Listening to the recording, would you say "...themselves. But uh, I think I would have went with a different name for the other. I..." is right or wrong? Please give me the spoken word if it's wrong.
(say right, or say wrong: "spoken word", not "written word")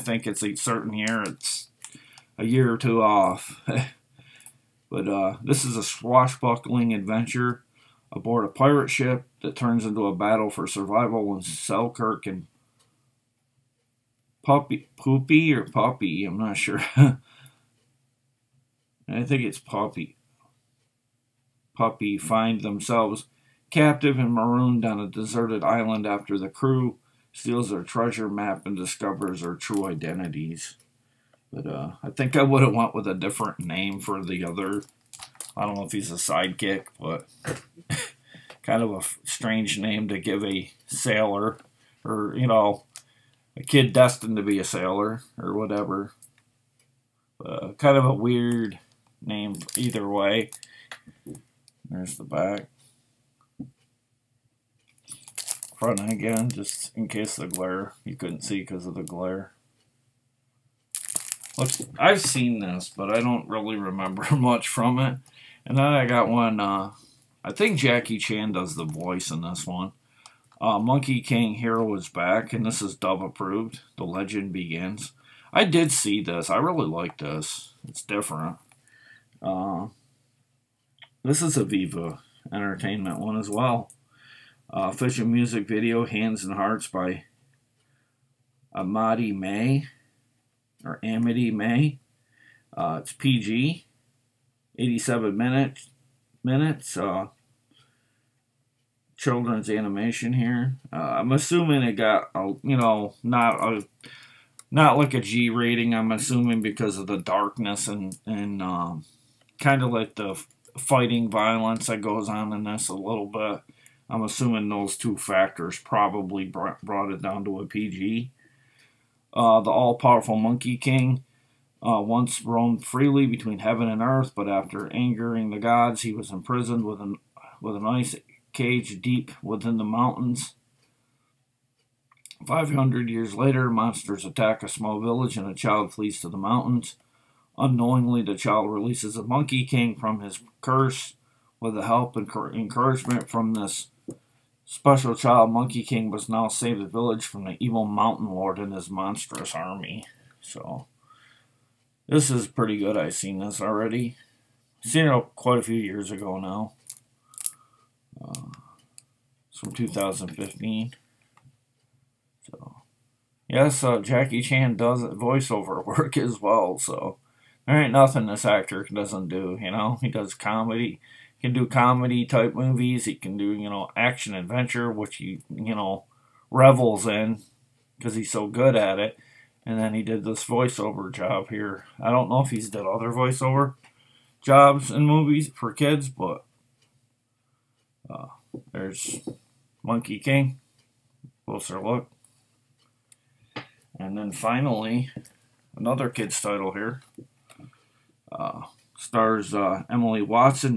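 wrong: "identities", not "themselves".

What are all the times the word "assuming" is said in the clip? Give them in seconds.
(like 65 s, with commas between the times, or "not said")
101 s, 106 s, 114 s.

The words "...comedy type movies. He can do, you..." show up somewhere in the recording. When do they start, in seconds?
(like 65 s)
171 s.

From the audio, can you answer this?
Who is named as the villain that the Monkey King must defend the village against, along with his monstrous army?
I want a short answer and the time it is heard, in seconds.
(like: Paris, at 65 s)
Mountain Lord, at 147 s.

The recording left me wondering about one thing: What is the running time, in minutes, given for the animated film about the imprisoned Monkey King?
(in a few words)
87.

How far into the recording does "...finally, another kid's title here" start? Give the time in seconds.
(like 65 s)
194 s.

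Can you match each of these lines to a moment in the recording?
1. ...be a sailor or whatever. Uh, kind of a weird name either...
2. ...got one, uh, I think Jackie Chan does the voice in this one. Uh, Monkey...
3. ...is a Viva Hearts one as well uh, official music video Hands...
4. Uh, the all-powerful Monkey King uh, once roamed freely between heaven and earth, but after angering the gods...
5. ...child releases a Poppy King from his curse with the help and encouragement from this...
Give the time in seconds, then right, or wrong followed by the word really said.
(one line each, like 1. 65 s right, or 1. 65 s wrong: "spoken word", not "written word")
1. 44 s right
2. 66 s right
3. 81 s wrong: "Entertainment", not "Hearts"
4. 119 s right
5. 138 s wrong: "Monkey", not "Poppy".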